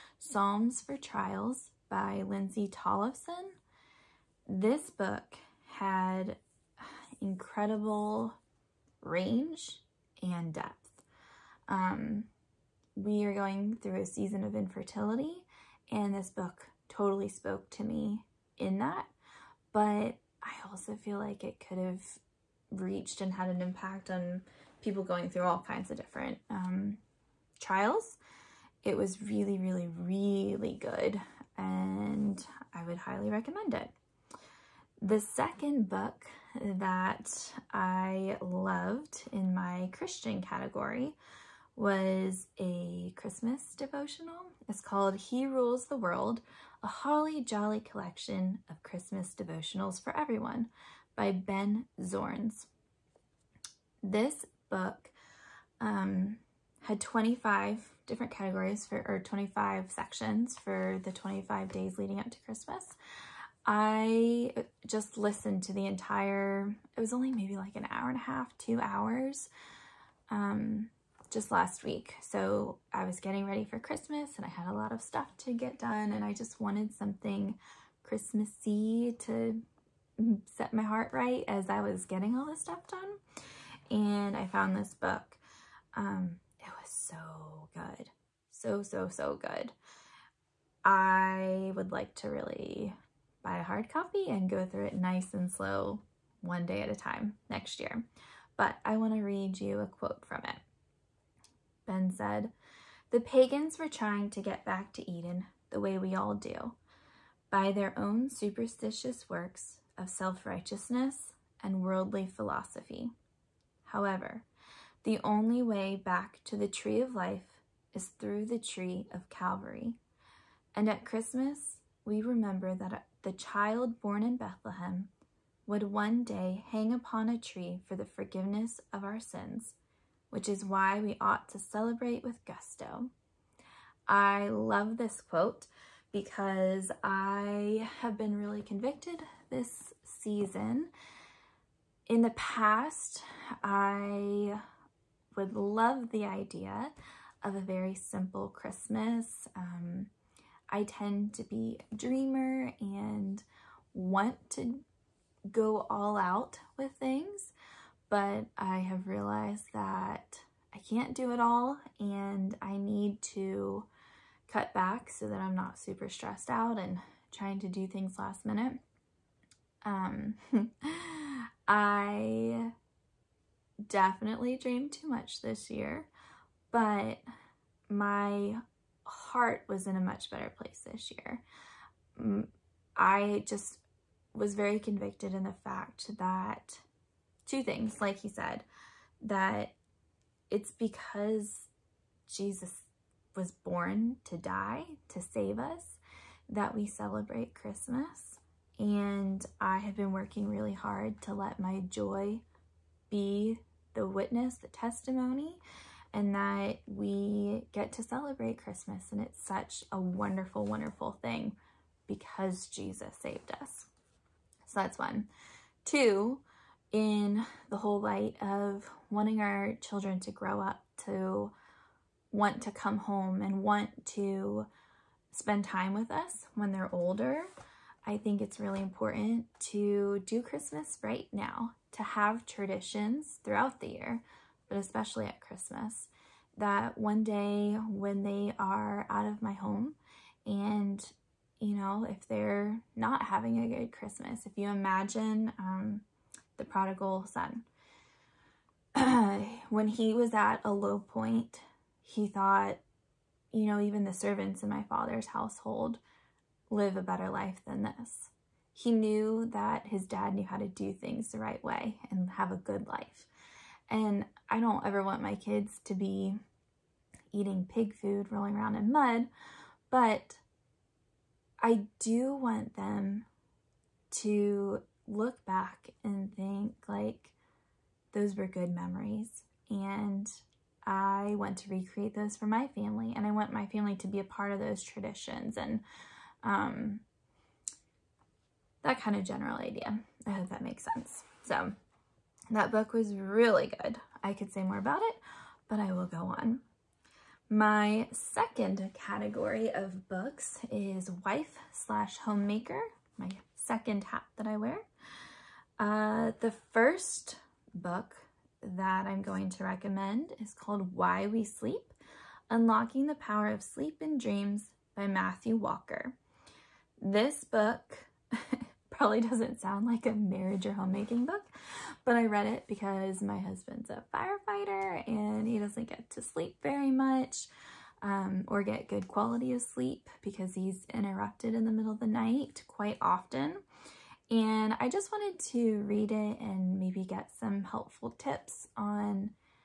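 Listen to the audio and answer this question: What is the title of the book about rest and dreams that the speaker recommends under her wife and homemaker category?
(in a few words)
Why We Sleep.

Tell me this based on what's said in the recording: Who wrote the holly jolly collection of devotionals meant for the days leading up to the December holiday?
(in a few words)
Ben Zornes.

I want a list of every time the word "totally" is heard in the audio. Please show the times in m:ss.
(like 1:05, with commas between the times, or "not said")
0:16.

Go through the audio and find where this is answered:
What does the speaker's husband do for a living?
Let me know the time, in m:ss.
5:24.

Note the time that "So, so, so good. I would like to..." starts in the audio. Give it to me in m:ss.
1:28.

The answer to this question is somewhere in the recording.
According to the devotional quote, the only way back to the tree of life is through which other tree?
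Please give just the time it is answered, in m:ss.
1:58.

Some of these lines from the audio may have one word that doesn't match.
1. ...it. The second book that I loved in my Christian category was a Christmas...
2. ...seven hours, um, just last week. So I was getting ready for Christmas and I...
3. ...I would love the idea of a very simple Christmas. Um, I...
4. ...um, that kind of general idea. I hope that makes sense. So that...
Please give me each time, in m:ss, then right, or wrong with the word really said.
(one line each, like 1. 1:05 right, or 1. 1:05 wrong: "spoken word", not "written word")
1. 0:33 right
2. 1:08 wrong: "two", not "seven"
3. 2:23 right
4. 4:46 right.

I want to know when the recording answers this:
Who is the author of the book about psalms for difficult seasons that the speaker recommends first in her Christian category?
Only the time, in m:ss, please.
0:02.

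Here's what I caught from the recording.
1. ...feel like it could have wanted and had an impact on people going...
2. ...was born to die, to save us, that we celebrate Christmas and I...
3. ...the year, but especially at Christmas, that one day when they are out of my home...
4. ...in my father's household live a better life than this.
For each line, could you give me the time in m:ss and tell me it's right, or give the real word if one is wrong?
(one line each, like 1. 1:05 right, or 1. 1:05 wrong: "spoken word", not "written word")
1. 0:20 wrong: "reached", not "wanted"
2. 3:13 right
3. 3:53 right
4. 4:14 right.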